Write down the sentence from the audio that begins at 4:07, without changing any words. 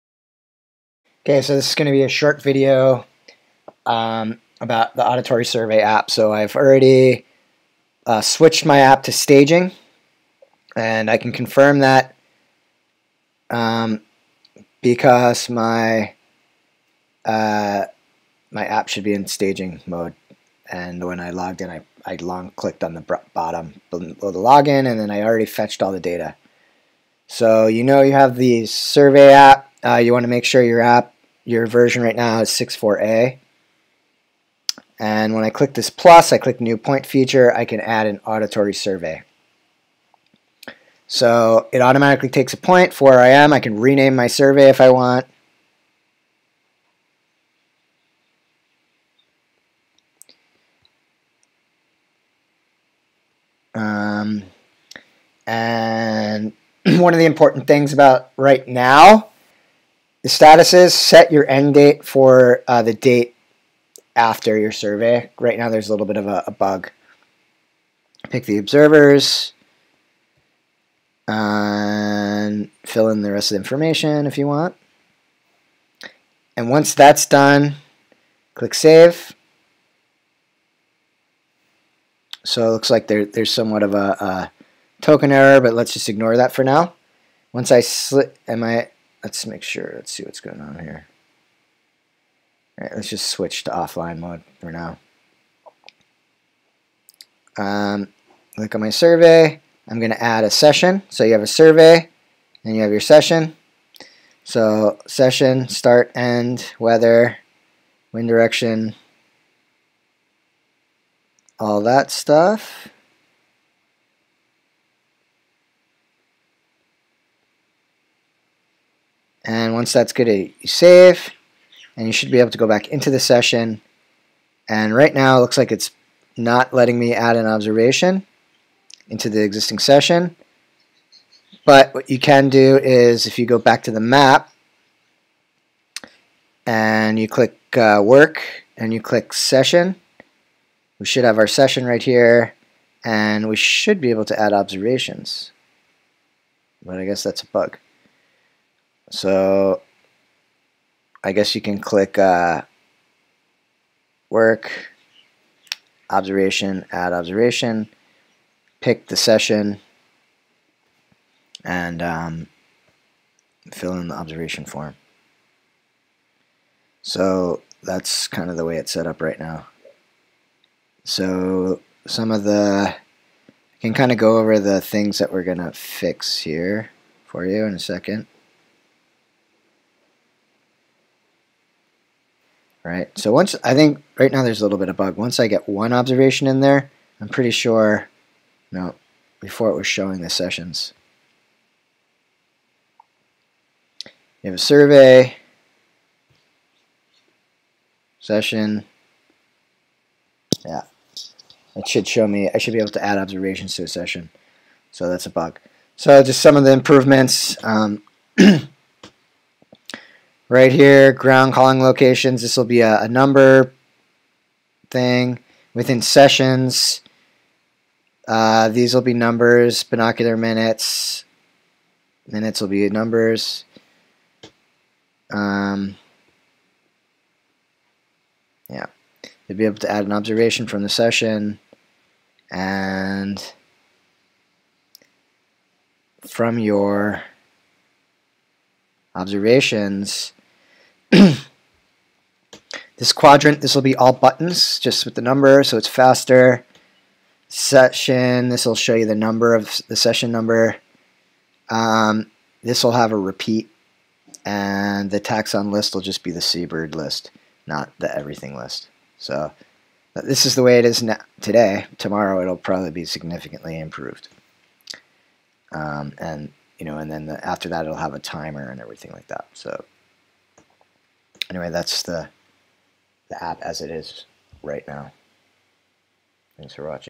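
Session, this will show you the number of the session number.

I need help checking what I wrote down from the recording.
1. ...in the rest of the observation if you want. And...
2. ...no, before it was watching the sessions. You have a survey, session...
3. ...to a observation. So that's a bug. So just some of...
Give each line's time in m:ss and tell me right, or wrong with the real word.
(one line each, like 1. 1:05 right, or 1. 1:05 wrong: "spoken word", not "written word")
1. 1:13 wrong: "information", not "observation"
2. 3:08 wrong: "showing", not "watching"
3. 3:23 wrong: "session", not "observation".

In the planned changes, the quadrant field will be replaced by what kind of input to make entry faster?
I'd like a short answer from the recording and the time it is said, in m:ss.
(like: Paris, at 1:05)
buttons, at 4:04.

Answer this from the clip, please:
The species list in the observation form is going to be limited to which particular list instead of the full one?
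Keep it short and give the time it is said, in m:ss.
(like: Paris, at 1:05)
seabird list, at 4:16.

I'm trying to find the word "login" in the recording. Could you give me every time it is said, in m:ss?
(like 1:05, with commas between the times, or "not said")
0:24.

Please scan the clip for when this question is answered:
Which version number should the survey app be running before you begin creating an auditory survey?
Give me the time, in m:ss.
0:32.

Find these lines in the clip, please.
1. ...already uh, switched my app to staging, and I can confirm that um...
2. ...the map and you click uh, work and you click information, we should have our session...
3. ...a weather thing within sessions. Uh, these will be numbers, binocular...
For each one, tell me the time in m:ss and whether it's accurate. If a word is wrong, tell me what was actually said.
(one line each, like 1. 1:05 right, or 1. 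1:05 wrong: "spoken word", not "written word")
1. 0:06 right
2. 2:13 wrong: "session", not "information"
3. 3:33 wrong: "number", not "weather".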